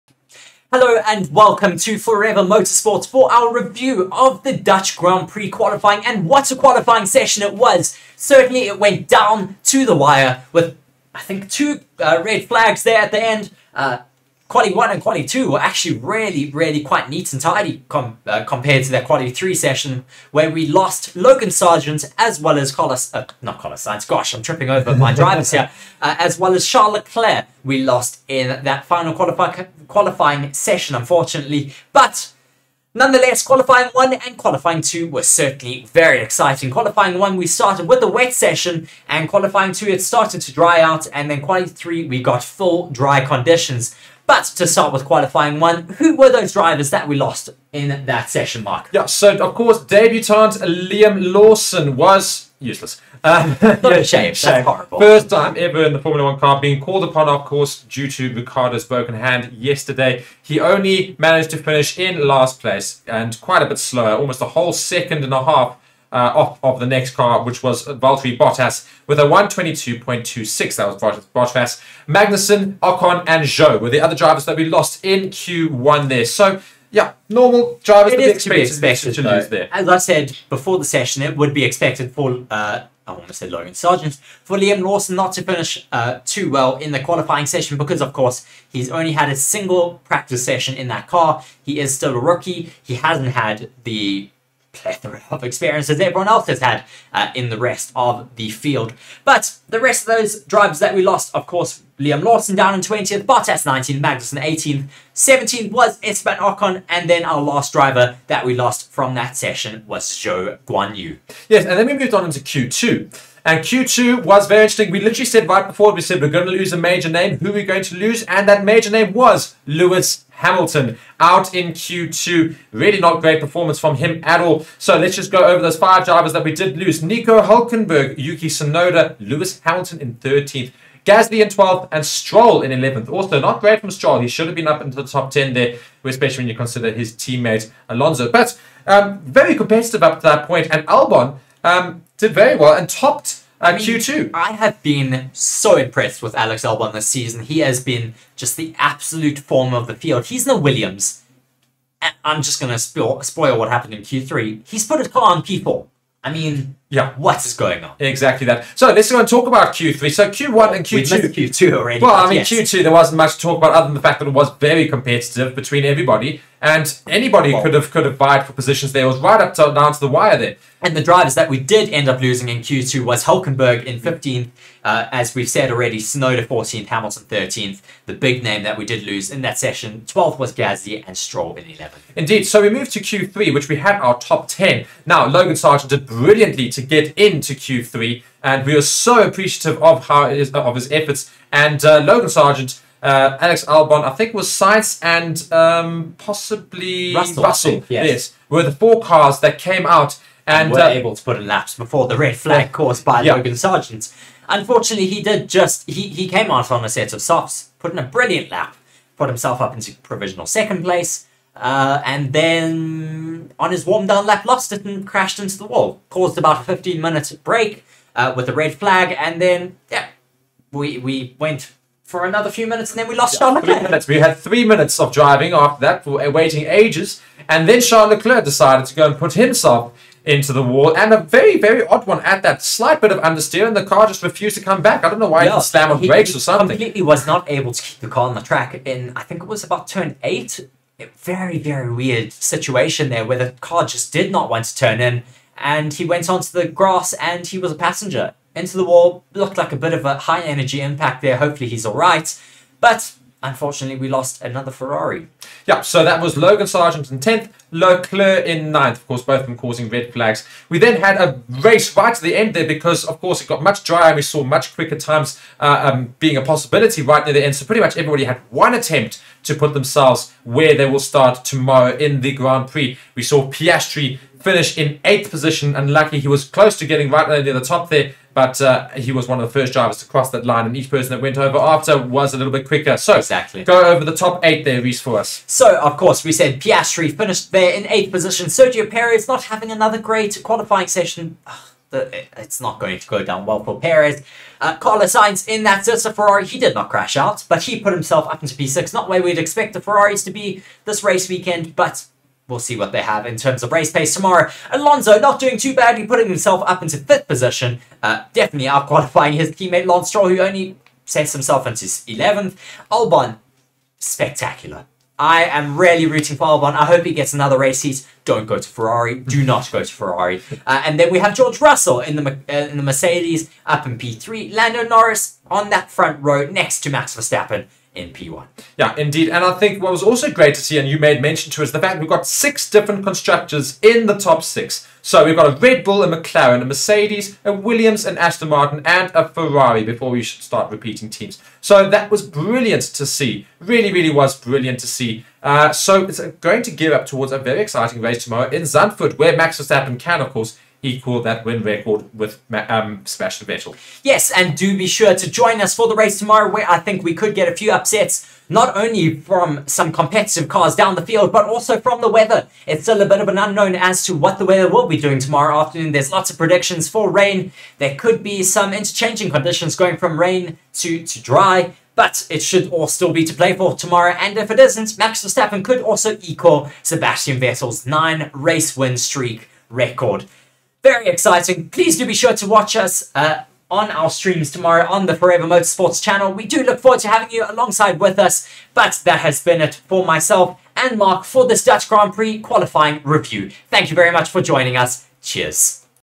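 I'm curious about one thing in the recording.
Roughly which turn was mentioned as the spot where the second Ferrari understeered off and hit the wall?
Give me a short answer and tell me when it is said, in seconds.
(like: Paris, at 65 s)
Turn 8, at 239 s.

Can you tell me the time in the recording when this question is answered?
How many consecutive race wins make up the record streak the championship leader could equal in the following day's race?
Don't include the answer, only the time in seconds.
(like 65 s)
377 s.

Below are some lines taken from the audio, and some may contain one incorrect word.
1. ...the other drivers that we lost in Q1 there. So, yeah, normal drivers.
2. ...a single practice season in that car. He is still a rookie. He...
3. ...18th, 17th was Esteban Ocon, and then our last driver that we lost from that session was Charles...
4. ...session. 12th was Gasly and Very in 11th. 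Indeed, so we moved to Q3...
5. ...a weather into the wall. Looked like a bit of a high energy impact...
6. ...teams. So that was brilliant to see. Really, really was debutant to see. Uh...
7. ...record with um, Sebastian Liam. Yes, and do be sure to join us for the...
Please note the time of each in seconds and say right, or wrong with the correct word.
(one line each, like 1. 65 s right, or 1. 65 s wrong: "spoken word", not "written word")
1. 73 s right
2. 89 s wrong: "session", not "season"
3. 104 s wrong: "Zhou", not "Charles"
4. 179 s wrong: "Stroll", not "Very"
5. 247 s wrong: "passenger", not "weather"
6. 341 s wrong: "brilliant", not "debutant"
7. 351 s wrong: "Vettel", not "Liam".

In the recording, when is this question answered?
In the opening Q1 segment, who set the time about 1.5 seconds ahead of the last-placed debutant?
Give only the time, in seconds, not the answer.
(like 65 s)
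67 s.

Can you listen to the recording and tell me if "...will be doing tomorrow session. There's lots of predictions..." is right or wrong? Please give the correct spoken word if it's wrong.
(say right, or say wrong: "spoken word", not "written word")
wrong: "afternoon", not "session".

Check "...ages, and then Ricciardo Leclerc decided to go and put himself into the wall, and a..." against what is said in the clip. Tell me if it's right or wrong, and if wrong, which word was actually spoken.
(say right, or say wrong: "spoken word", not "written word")
wrong: "Charles", not "Ricciardo".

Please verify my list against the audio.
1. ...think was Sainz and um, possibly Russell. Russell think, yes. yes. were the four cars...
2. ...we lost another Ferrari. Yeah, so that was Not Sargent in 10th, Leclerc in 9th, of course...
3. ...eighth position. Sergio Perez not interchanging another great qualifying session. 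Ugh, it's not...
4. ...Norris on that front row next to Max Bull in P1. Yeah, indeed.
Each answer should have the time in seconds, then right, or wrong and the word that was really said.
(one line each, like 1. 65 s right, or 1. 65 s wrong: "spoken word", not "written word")
1. 194 s right
2. 253 s wrong: "Logan", not "Not"
3. 287 s wrong: "having", not "interchanging"
4. 324 s wrong: "Verstappen", not "Bull".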